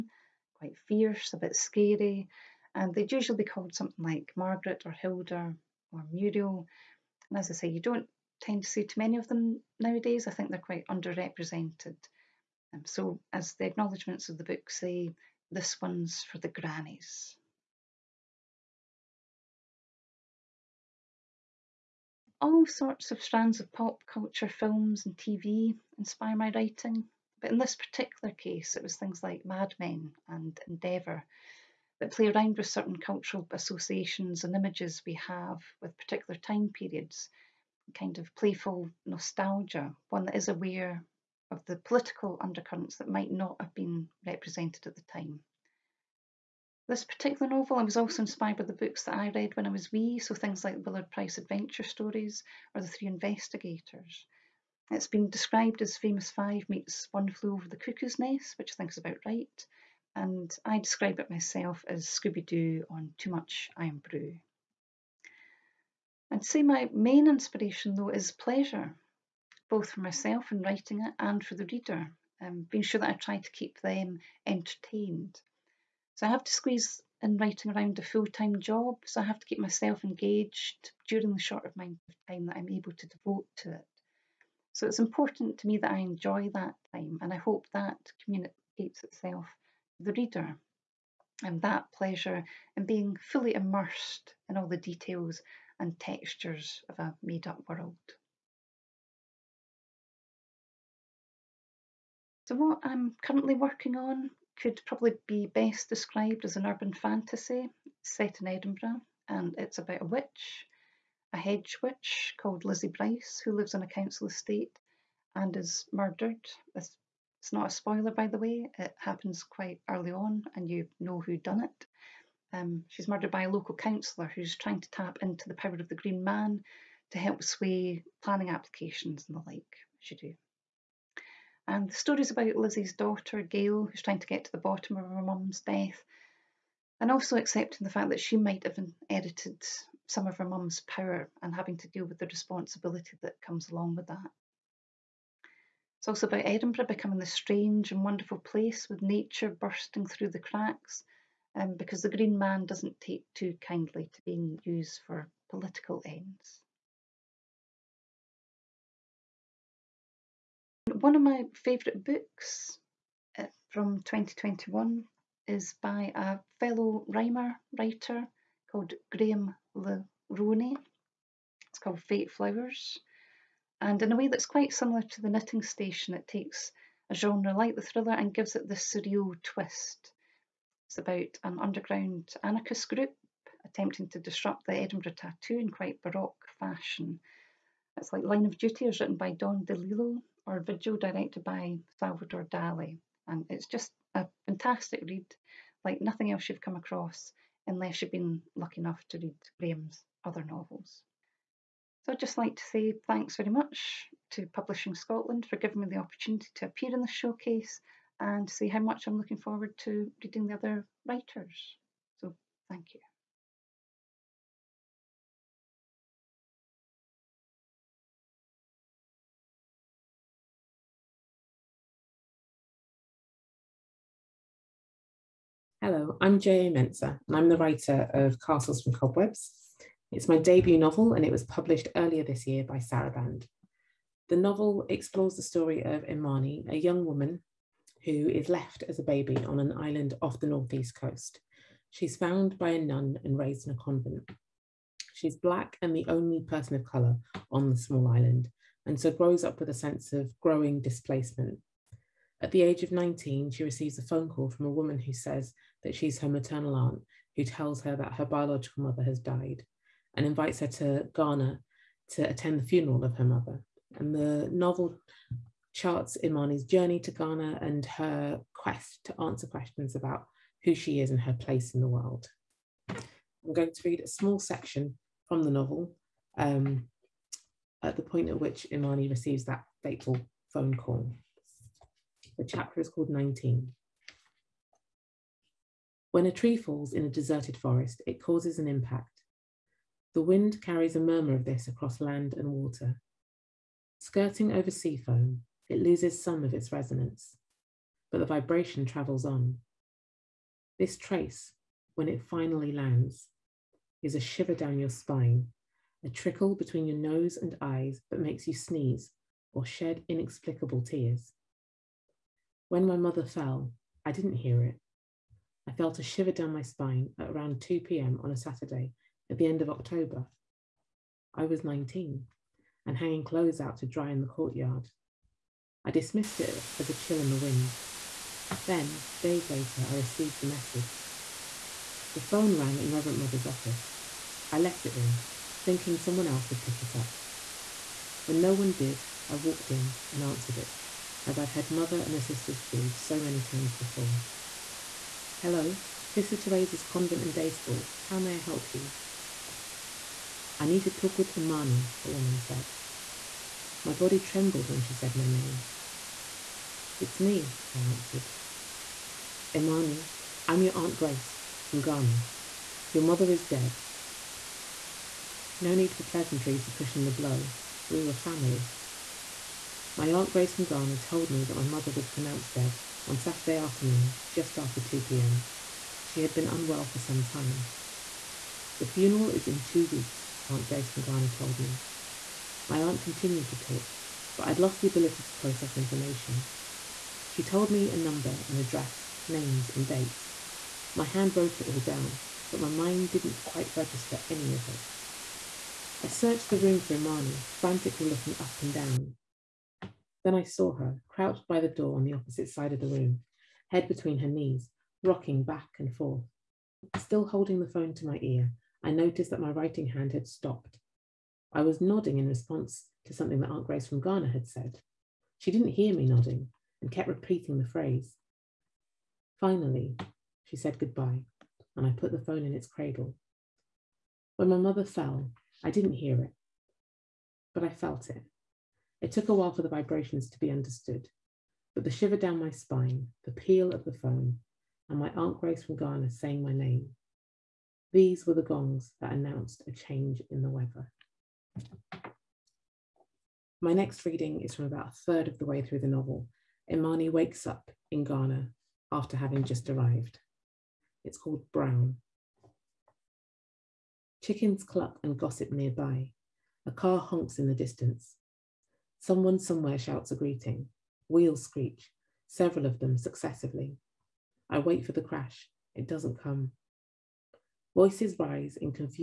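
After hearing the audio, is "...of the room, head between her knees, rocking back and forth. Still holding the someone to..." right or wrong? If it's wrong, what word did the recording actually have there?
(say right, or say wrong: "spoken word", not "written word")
wrong: "phone", not "someone".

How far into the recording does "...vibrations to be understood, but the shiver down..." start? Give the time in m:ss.
7:09.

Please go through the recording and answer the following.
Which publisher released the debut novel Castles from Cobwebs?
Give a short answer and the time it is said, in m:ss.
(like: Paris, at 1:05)
Saraband, at 3:52.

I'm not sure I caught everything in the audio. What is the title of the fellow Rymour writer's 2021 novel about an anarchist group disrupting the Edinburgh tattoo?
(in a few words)
Fate Flowers.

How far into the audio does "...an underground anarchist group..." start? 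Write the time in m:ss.
3:01.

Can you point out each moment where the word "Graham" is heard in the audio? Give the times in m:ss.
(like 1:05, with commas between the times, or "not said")
2:49, 3:19.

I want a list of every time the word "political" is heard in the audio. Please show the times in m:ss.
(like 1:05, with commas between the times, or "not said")
0:41, 2:35.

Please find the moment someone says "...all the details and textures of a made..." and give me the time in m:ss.
1:34.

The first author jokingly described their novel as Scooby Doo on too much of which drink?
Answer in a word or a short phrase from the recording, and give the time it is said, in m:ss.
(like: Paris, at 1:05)
Irn-Bru, at 1:03.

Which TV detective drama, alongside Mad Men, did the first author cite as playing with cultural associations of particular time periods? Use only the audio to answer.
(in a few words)
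Endeavour.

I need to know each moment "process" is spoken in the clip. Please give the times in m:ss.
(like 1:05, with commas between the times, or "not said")
6:25.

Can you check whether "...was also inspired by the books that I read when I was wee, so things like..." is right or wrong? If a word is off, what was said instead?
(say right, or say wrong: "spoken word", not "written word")
right.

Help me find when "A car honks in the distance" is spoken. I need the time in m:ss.
7:36.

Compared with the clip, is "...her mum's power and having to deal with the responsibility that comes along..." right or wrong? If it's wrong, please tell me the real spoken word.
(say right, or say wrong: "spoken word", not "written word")
right.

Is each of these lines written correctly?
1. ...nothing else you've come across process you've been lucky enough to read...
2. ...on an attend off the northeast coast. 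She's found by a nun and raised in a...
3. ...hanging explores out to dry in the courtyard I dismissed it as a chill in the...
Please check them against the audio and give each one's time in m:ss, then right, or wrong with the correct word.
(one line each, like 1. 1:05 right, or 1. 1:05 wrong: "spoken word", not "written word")
1. 3:15 wrong: "unless", not "process"
2. 3:59 wrong: "island", not "attend"
3. 5:22 wrong: "clothes", not "explores".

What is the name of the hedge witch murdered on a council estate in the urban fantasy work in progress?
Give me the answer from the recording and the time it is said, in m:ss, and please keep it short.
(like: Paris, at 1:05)
Lizzie Bryce, at 1:52.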